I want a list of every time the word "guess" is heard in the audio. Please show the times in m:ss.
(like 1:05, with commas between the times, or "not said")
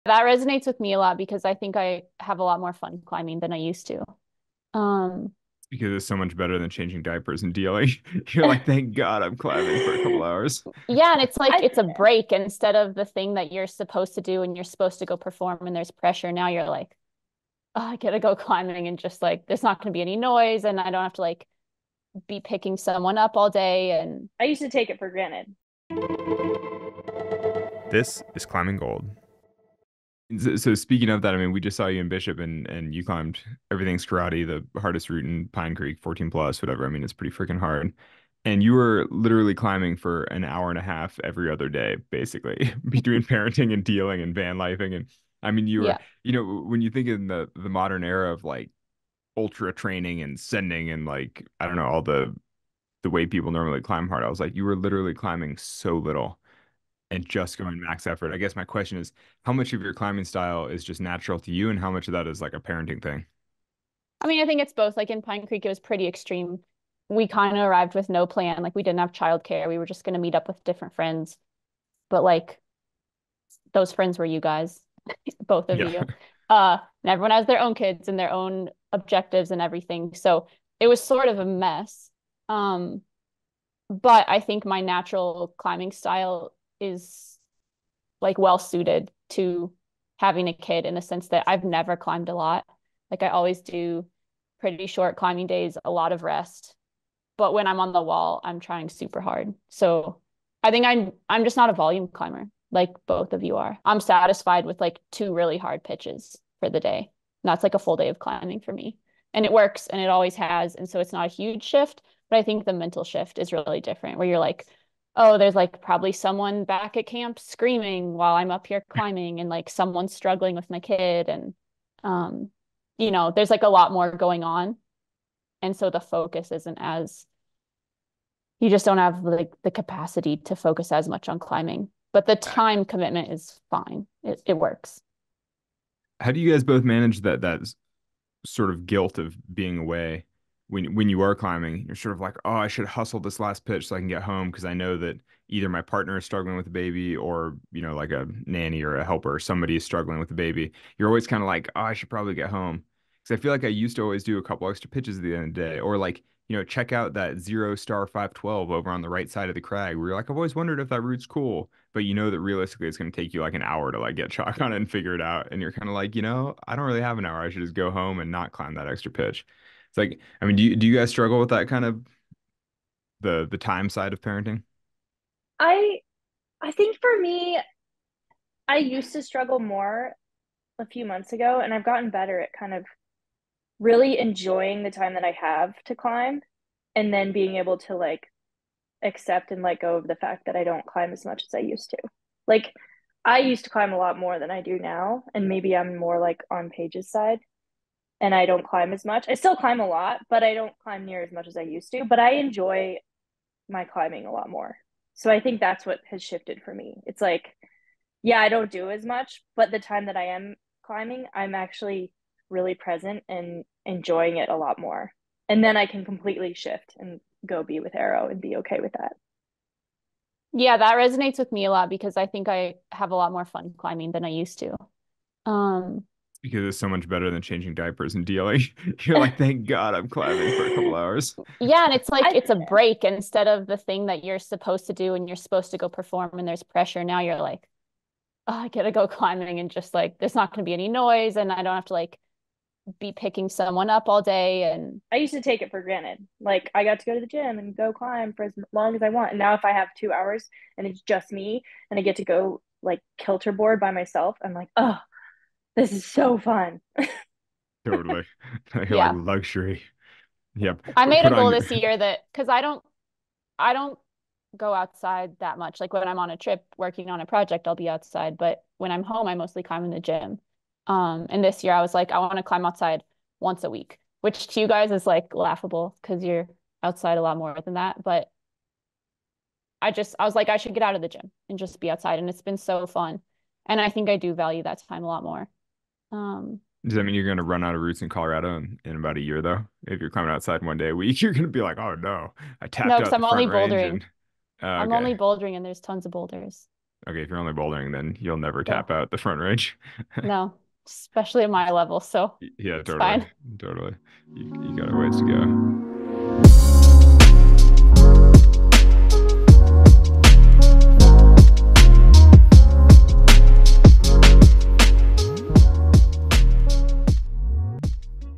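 0:58.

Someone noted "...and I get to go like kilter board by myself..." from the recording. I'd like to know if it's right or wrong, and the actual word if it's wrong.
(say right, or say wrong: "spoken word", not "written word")
right.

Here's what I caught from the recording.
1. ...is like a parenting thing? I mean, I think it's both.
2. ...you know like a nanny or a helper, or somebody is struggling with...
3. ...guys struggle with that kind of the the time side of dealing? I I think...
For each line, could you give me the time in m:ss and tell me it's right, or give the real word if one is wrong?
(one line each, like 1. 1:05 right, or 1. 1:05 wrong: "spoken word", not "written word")
1. 1:02 right
2. 2:27 right
3. 2:50 wrong: "parenting", not "dealing".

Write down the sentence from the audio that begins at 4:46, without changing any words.
Um, Does that mean you're going to run out of routes in Colorado in, in, about a year, though?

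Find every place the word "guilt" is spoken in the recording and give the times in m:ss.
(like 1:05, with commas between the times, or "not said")
2:18.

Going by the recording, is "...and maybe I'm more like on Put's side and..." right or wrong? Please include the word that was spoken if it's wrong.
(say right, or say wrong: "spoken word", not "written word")
wrong: "Paige", not "Put".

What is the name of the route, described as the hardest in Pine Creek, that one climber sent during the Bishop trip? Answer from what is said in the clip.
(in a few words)
Everything's Karate.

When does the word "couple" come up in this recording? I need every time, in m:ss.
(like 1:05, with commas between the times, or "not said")
0:10, 2:34, 3:50.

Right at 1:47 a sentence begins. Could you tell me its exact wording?
And that's like a full day of climbing for me.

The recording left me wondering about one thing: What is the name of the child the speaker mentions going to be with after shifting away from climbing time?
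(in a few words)
Arrow.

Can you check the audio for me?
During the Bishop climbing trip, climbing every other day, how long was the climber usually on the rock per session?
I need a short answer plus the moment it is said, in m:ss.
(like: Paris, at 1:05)
an hour and a half, at 0:40.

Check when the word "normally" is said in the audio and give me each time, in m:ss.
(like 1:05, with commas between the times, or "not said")
0:53.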